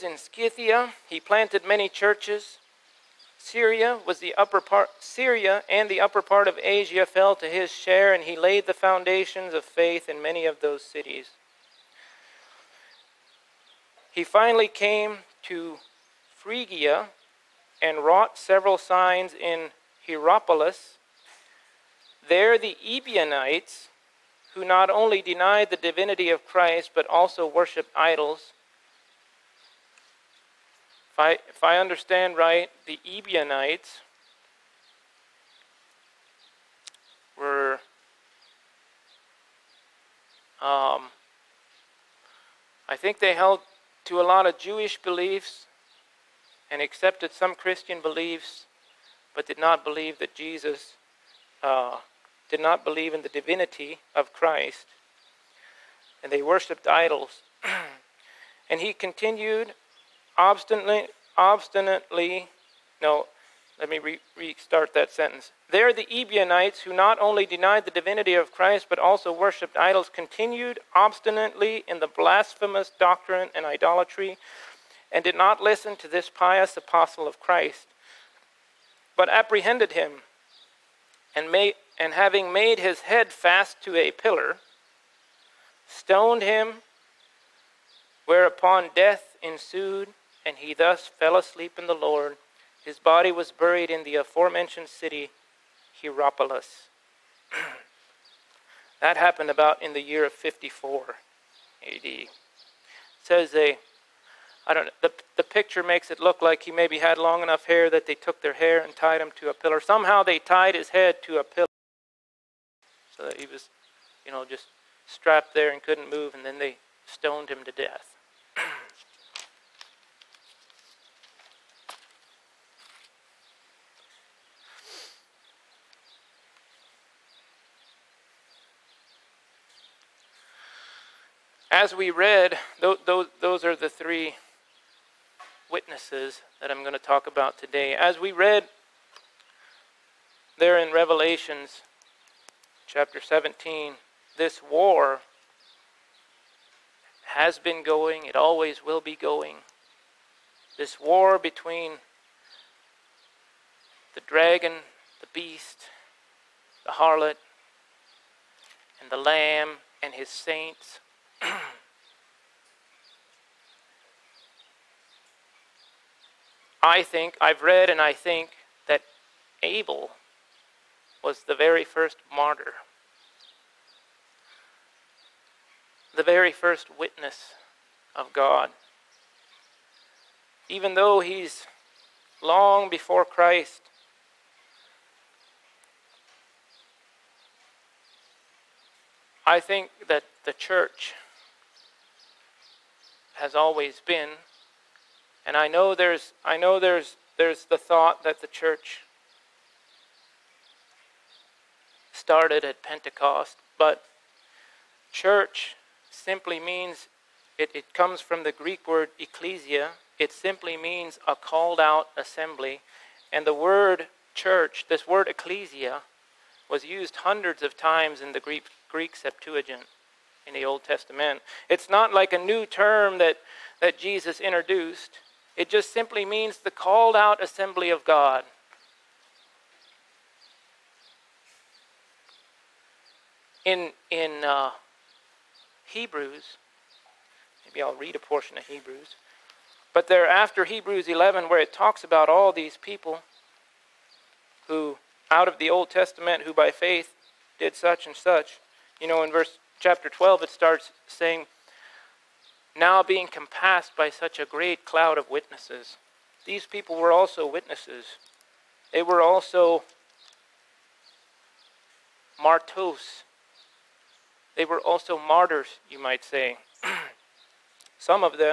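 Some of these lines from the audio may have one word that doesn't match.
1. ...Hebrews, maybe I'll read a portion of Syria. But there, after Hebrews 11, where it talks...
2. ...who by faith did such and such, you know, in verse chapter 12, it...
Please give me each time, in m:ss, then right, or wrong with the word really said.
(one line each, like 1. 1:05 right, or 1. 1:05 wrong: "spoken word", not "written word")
1. 3:55 wrong: "Hebrews", not "Syria"
2. 4:06 right.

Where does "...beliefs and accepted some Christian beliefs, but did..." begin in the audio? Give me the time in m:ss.
0:45.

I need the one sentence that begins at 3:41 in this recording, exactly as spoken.
It's not like a new term that, that Jesus introduced, it just simply means the called out assembly of God.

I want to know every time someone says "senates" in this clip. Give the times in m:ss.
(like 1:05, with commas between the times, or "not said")
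not said.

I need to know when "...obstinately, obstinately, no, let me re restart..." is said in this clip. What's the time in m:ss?
1:00.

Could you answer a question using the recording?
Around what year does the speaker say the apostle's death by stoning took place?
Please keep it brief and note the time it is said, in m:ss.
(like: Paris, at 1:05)
54 AD, at 1:40.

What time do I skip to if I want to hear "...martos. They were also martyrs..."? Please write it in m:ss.
4:22.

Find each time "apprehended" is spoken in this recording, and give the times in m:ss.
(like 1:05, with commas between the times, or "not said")
1:19.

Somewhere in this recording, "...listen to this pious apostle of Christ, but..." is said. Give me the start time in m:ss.
1:15.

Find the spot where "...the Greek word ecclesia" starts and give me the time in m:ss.
3:28.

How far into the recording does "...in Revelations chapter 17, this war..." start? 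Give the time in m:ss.
2:20.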